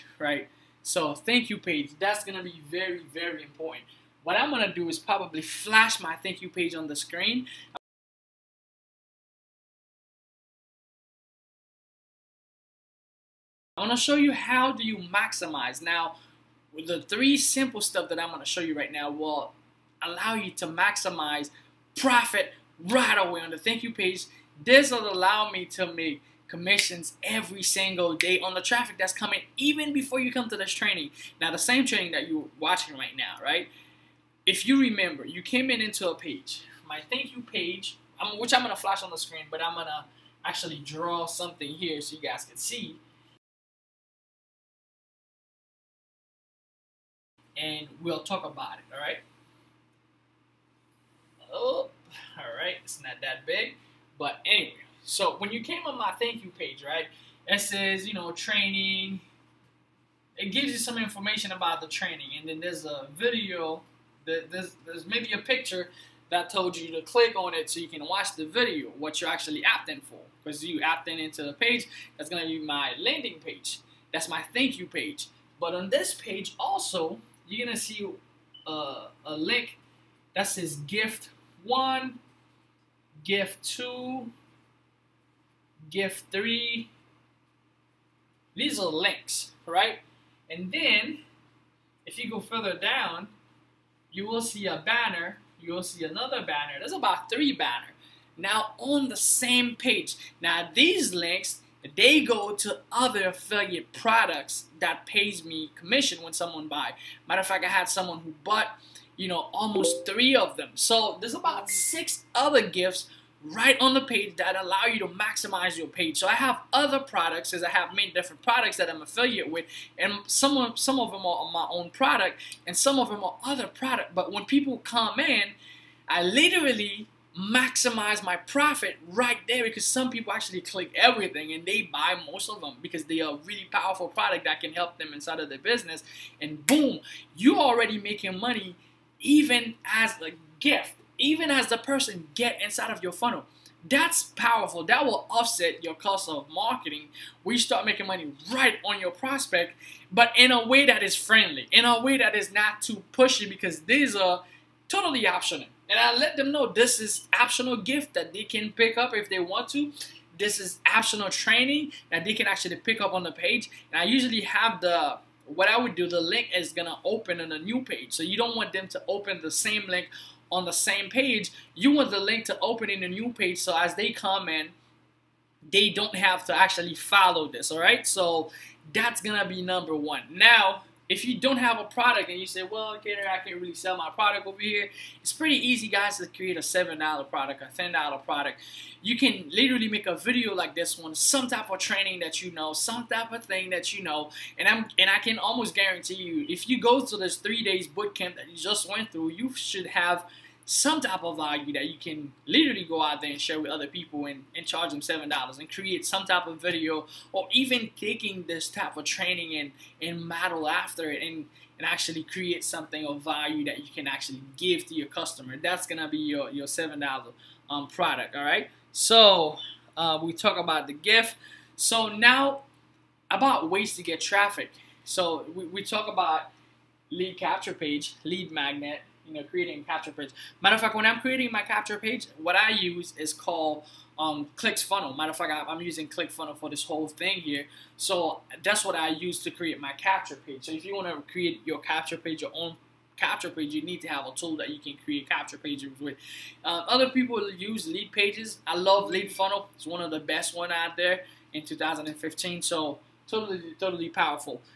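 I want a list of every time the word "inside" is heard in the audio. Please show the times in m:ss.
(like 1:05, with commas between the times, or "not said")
2:15, 2:22.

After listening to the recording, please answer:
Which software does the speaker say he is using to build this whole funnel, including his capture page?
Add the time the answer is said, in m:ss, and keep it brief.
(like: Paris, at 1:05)
ClickFunnel, at 3:56.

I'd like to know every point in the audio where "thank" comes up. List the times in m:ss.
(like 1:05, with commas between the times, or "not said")
0:01, 0:06, 0:23, 0:37, 0:56, 1:14.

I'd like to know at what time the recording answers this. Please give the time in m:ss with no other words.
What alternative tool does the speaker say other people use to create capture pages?
4:07.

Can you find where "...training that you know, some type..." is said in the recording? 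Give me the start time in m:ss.
3:11.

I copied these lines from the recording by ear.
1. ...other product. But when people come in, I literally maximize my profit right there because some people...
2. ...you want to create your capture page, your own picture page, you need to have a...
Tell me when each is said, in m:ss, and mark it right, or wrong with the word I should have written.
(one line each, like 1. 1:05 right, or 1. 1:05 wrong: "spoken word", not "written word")
1. 2:03 right
2. 4:00 wrong: "capture", not "picture".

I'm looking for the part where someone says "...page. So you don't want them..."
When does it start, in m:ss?
2:47.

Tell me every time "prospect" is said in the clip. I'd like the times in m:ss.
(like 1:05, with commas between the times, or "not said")
2:29.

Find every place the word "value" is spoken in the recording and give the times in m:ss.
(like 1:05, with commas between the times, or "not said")
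3:21, 3:33.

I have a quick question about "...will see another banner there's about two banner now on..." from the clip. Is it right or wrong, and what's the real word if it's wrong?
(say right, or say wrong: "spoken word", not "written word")
wrong: "three", not "two".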